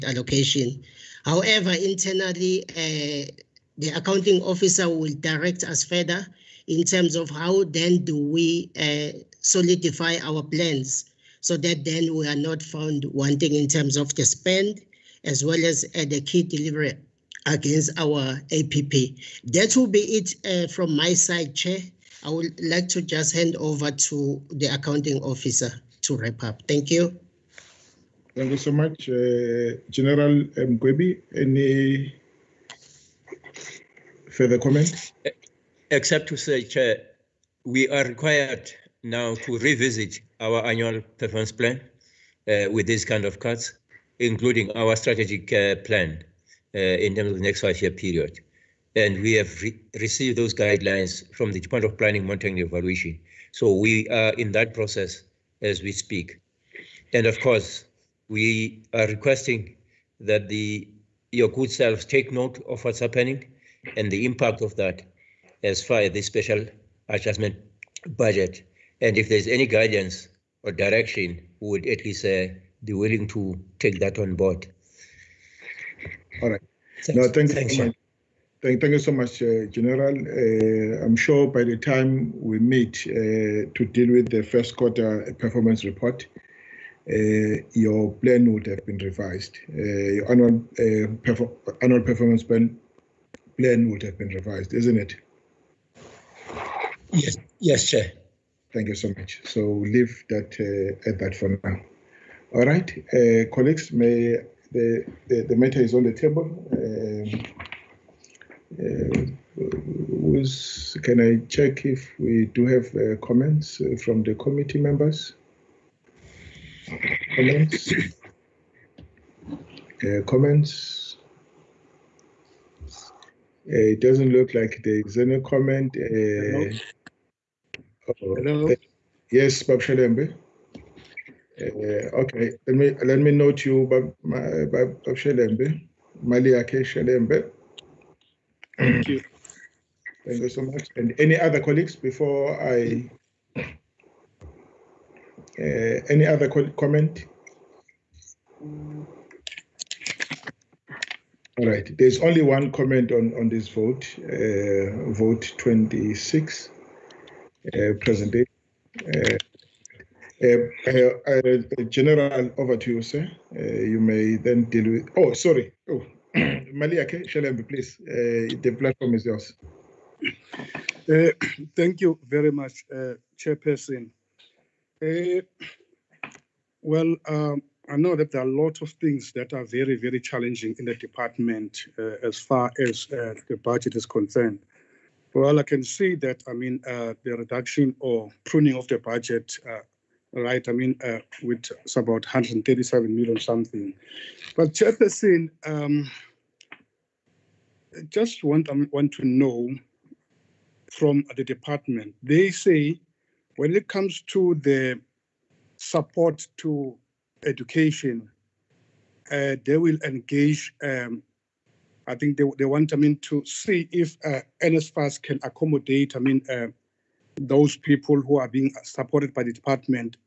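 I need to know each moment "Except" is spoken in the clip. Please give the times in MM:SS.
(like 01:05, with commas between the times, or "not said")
00:35.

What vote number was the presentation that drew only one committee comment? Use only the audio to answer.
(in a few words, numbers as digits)
26.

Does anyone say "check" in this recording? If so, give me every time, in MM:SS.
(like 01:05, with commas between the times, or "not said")
01:51.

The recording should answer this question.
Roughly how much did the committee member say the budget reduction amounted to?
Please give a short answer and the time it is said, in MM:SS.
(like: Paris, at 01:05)
137 million, at 03:12.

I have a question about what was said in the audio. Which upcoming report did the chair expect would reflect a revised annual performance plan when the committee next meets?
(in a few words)
first quarter performance report.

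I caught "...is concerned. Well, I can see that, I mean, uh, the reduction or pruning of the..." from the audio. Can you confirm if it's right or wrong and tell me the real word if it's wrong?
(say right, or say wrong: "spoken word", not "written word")
right.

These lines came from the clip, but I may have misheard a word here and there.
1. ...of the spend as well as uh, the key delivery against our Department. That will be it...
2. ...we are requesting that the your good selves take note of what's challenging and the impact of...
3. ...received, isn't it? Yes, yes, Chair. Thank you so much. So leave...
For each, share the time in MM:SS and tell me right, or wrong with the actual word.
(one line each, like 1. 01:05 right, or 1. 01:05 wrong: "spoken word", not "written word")
1. 00:13 wrong: "APP", not "Department"
2. 00:58 wrong: "happening", not "challenging"
3. 01:34 wrong: "revised", not "received".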